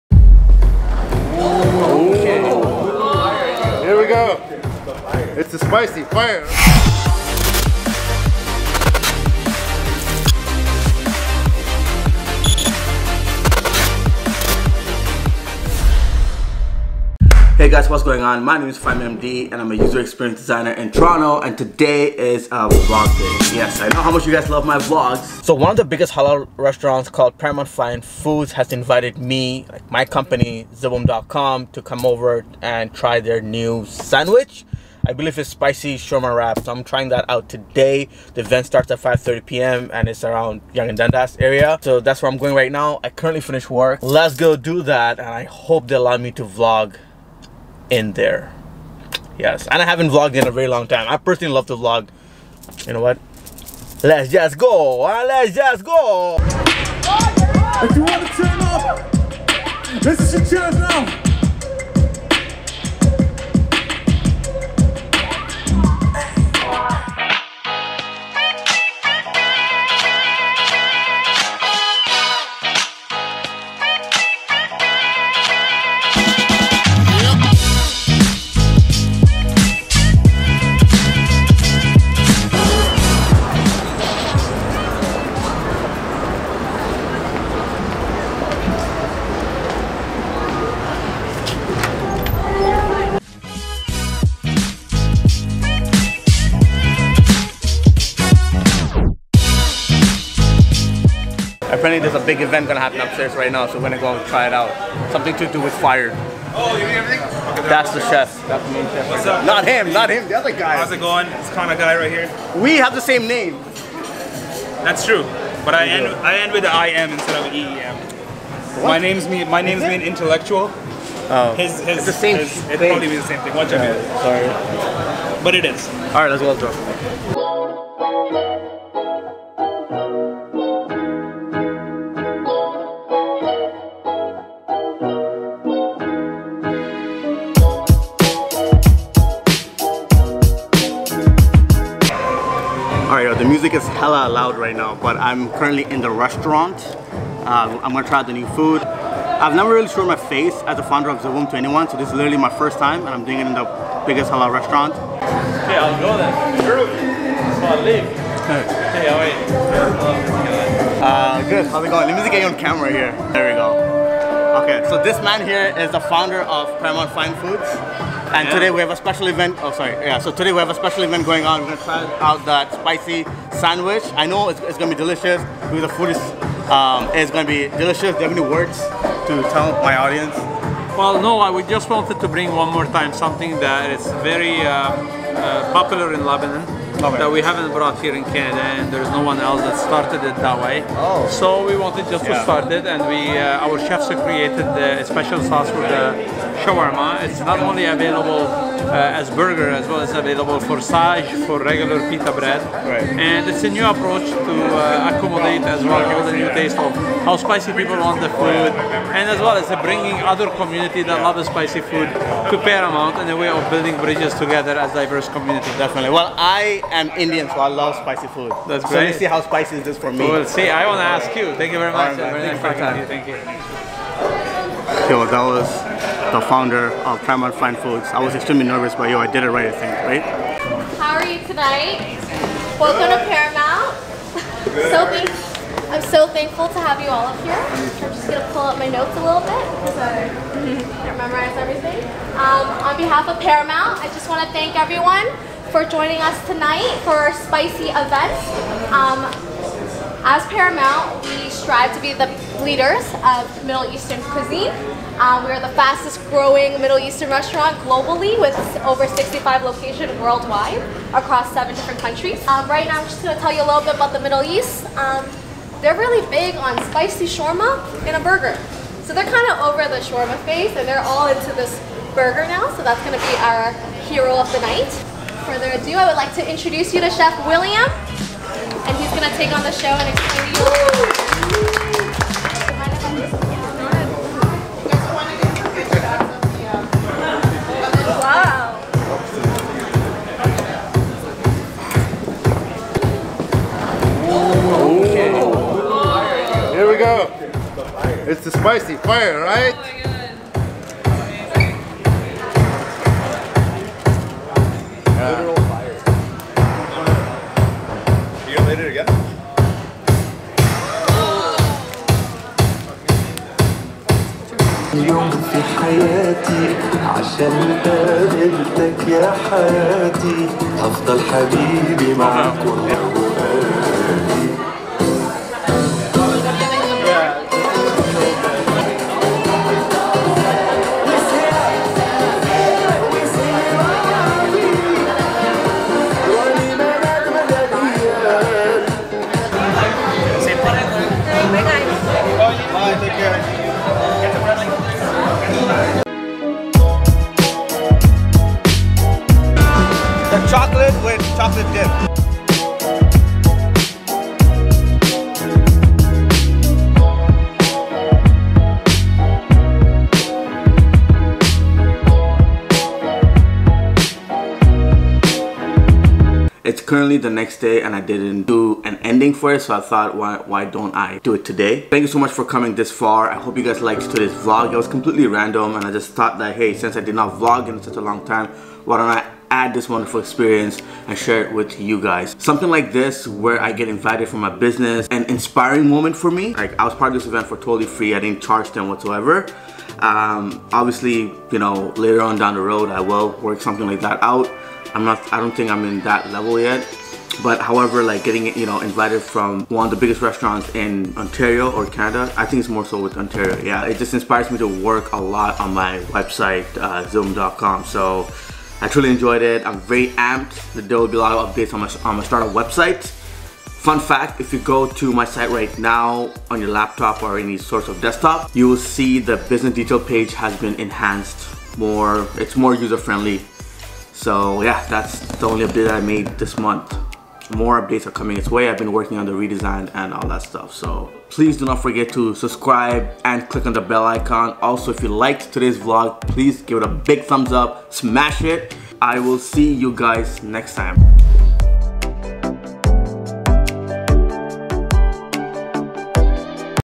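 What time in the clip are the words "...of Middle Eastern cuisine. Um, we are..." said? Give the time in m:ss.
4:13.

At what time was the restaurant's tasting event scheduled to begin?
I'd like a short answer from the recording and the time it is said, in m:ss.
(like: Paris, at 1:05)
5:30 p.m., at 0:38.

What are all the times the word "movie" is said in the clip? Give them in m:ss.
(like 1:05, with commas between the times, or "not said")
not said.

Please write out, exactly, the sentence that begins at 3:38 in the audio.
So let's see how spicy is this for me.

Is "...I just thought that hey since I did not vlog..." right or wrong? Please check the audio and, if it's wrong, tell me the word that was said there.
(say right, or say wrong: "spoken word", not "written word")
right.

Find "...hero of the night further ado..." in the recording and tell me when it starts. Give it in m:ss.
4:34.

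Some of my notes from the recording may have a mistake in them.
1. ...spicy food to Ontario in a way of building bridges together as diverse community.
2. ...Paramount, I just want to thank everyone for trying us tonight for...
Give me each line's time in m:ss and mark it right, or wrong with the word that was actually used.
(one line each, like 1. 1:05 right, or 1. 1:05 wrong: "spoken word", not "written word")
1. 3:31 wrong: "Paramount", not "Ontario"
2. 4:03 wrong: "joining", not "trying".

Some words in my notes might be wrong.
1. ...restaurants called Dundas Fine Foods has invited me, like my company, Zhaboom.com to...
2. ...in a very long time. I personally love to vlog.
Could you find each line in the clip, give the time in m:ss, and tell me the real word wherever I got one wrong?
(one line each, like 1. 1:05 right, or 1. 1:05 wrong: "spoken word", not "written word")
1. 0:26 wrong: "Paramount", not "Dundas"
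2. 0:50 right.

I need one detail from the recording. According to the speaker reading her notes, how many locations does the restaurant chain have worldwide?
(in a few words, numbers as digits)
Over 65.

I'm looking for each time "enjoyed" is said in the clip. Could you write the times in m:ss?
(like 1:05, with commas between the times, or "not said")
6:49.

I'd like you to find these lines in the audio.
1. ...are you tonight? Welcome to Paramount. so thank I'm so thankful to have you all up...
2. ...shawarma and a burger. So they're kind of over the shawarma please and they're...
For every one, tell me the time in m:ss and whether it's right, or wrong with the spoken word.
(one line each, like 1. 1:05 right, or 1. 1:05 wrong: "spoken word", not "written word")
1. 3:51 right
2. 4:27 wrong: "phase", not "please".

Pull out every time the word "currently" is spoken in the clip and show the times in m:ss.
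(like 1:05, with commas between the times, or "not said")
0:43, 2:25, 6:06.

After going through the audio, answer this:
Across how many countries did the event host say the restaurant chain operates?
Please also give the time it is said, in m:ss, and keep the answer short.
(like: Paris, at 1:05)
7, at 4:21.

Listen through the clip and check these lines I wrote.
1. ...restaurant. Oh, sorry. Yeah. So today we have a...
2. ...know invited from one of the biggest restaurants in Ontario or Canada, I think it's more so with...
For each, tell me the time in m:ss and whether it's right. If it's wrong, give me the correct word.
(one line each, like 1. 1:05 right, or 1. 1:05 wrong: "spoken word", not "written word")
1. 2:49 wrong: "event", not "restaurant"
2. 6:38 right.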